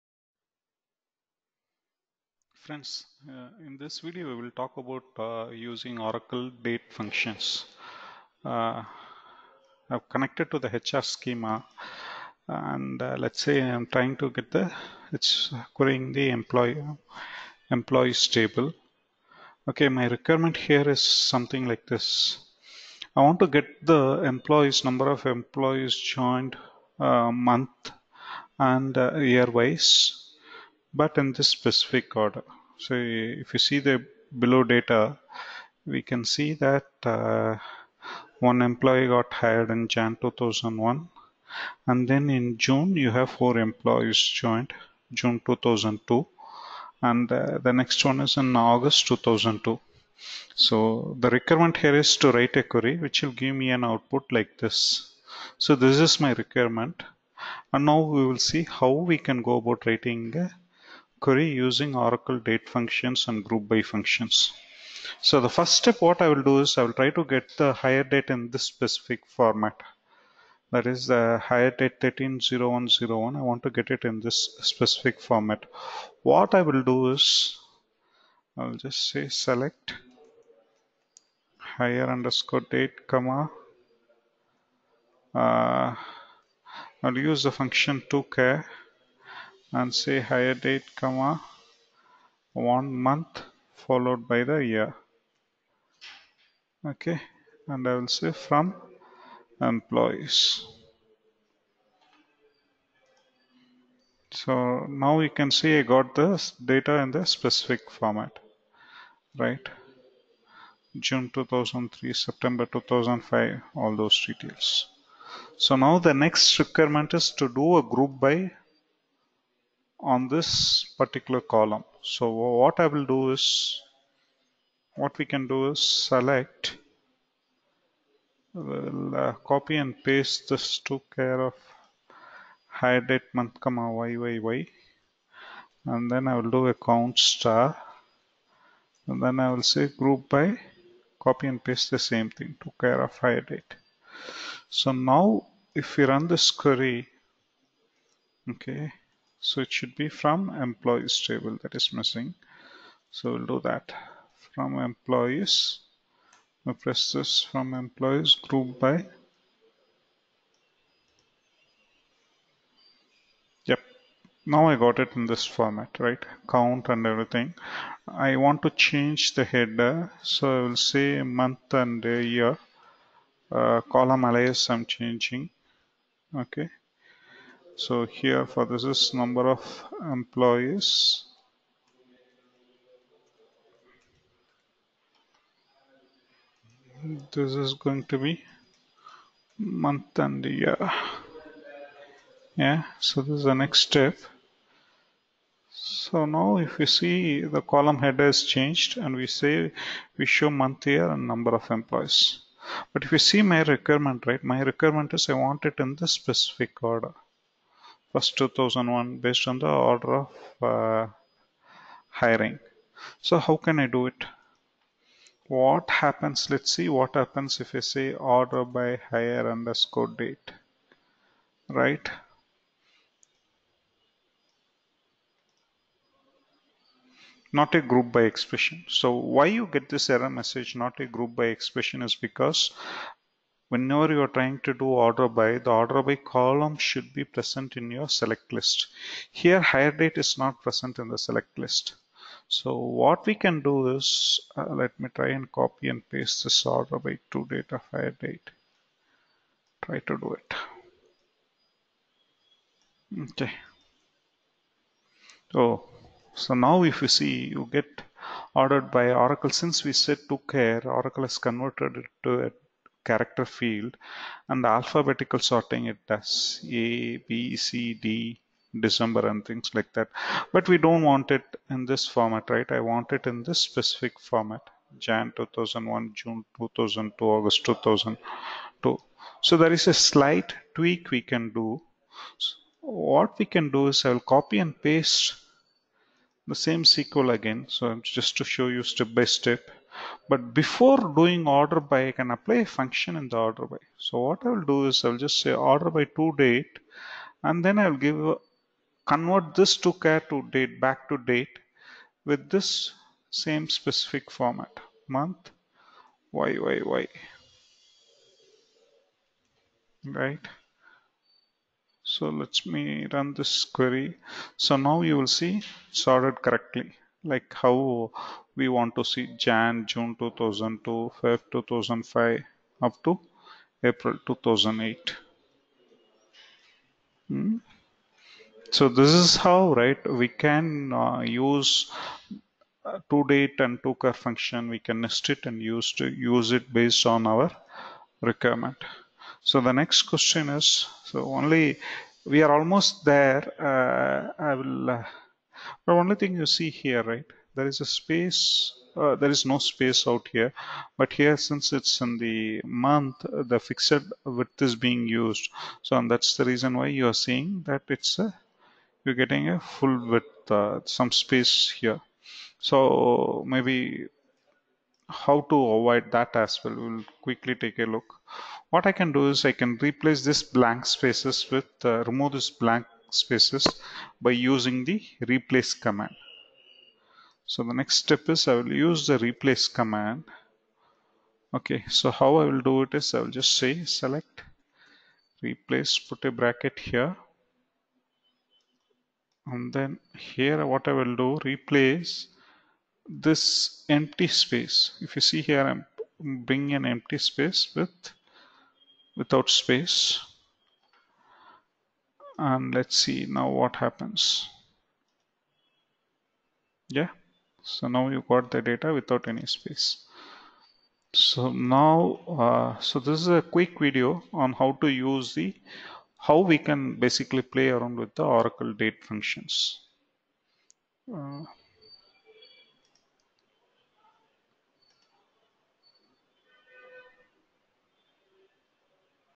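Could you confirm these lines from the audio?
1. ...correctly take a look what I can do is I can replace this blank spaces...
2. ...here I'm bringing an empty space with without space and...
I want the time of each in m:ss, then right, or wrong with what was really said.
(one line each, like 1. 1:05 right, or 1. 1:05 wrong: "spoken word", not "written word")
1. 6:07 wrong: "quickly", not "correctly"
2. 6:35 right.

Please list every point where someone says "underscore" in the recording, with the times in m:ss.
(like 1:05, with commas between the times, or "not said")
1:22, 3:39.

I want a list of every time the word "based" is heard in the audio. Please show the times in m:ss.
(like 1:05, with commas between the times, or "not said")
3:29, 5:36.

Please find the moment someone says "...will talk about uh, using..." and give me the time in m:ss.
0:04.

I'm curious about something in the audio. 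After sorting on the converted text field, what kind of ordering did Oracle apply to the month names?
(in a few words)
Alphabetical sorting.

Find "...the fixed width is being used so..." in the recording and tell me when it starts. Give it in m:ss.
5:53.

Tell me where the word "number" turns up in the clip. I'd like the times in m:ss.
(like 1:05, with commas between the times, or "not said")
0:24, 2:59, 3:21.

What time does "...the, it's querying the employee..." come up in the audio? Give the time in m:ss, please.
0:14.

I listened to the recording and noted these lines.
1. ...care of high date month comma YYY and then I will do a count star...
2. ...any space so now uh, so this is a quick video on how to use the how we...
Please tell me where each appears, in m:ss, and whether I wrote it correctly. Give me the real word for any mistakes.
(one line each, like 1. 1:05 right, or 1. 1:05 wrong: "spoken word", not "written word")
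1. 2:11 right
2. 6:49 right.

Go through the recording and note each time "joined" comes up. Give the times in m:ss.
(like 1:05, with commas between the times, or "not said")
0:25, 0:44.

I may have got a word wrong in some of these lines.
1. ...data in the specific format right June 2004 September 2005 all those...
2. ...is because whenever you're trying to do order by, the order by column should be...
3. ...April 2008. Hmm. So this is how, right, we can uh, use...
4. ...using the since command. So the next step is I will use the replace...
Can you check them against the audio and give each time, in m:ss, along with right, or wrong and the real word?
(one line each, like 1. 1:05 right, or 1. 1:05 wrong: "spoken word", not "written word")
1. 1:46 wrong: "2003", not "2004"
2. 3:52 right
3. 5:23 right
4. 6:14 wrong: "replace", not "since".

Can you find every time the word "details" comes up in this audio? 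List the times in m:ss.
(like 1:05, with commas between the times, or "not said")
1:54.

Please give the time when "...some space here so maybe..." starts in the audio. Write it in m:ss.
6:00.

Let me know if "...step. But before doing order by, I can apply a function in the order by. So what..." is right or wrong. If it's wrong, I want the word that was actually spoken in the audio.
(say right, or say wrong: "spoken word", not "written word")
right.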